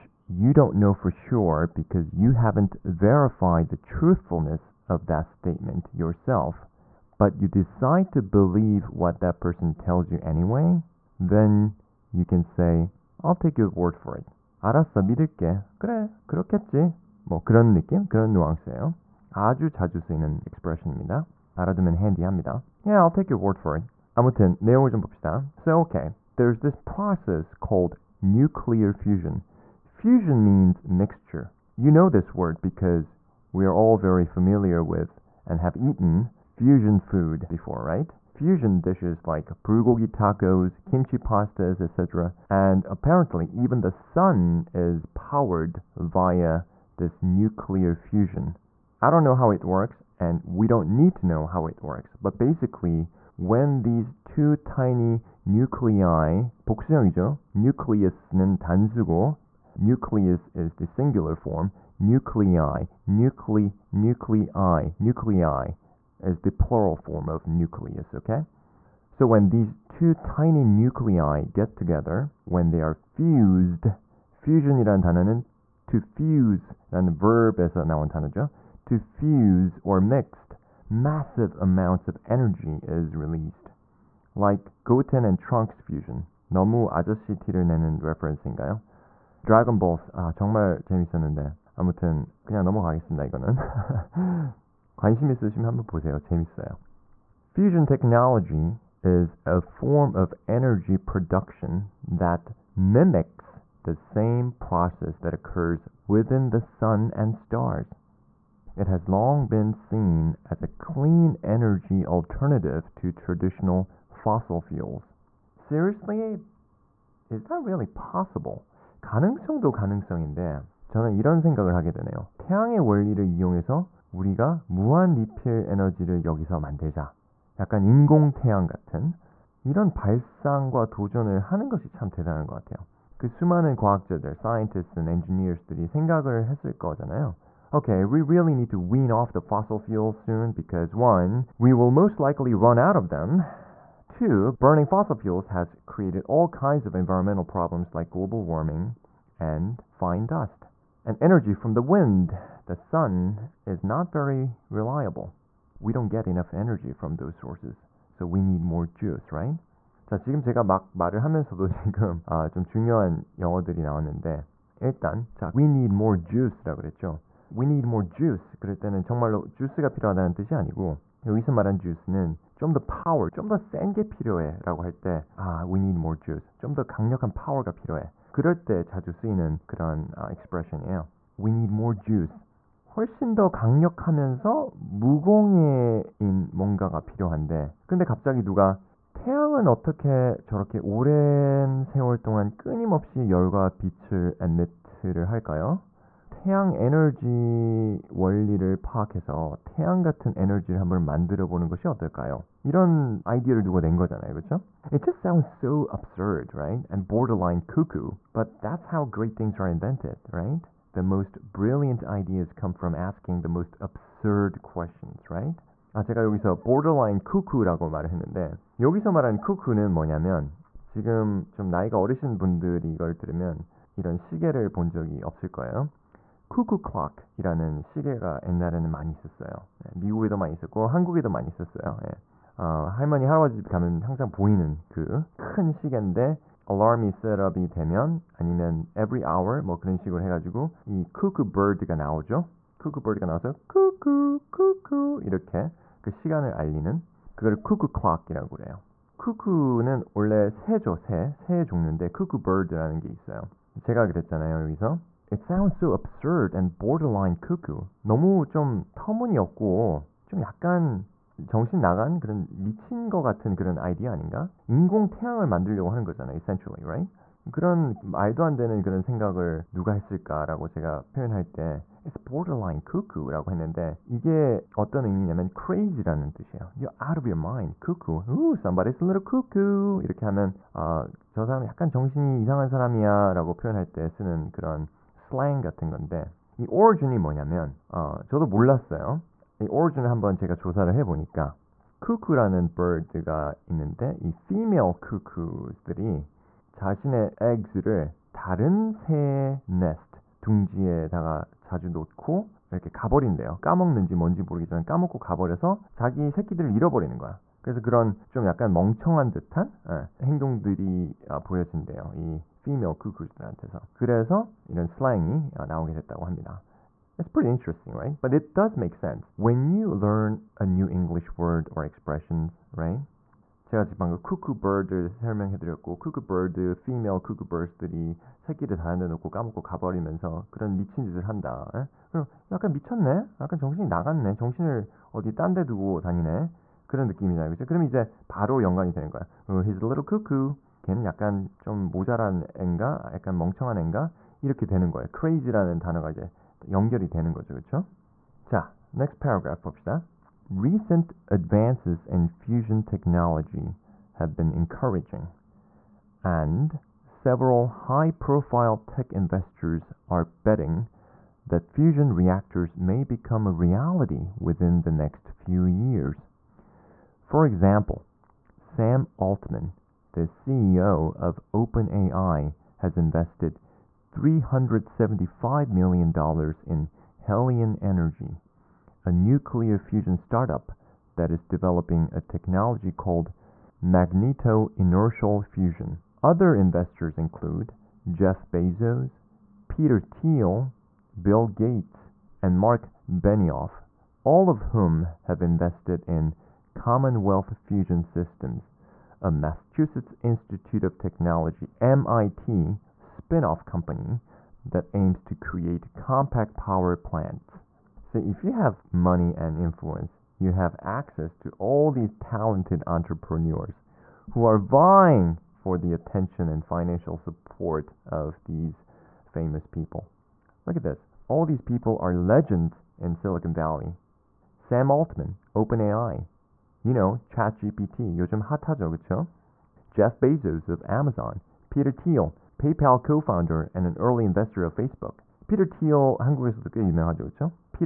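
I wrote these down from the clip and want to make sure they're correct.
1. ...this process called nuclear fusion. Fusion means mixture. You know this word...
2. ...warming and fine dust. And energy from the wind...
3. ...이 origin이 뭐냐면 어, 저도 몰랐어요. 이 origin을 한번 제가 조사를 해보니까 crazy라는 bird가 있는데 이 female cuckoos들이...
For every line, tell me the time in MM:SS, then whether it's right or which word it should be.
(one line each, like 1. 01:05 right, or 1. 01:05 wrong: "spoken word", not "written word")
1. 00:26 right
2. 02:28 right
3. 04:46 wrong: "cuckoo라는", not "crazy라는".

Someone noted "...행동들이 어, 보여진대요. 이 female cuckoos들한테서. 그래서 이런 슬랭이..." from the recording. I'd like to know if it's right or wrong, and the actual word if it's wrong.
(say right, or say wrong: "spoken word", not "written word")
right.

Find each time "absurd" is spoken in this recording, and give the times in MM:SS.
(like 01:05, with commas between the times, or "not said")
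03:25, 03:33, 04:15.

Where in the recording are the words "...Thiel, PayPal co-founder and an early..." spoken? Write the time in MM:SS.
07:11.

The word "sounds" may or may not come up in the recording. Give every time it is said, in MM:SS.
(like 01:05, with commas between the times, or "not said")
03:25, 04:15.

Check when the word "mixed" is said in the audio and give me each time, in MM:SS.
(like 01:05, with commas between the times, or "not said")
01:20.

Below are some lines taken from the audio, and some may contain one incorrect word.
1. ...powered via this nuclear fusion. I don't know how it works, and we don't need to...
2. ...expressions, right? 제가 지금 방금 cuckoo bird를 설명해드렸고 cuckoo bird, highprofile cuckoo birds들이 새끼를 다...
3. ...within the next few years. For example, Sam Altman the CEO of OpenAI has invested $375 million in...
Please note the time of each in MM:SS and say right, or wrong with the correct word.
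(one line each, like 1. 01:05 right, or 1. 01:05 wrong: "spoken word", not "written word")
1. 00:45 right
2. 05:21 wrong: "female", not "highprofile"
3. 06:04 right.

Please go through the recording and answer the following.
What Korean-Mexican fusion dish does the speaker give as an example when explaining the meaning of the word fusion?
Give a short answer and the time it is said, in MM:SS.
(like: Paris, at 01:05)
bulgogi tacos, at 00:39.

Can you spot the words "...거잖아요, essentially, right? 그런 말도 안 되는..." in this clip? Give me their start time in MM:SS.
04:26.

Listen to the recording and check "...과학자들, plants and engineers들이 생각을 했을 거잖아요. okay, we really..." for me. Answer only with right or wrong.
wrong.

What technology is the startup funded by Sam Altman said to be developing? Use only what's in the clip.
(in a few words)
magneto-inertial fusion.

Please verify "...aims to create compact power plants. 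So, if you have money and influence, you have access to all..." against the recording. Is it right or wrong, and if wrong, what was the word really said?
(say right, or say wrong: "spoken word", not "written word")
right.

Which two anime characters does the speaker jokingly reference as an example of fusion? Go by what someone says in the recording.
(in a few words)
Goten and Trunks.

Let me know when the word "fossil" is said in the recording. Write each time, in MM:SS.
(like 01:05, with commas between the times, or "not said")
01:54, 02:19, 02:24.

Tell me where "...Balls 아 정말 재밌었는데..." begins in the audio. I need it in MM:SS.
01:29.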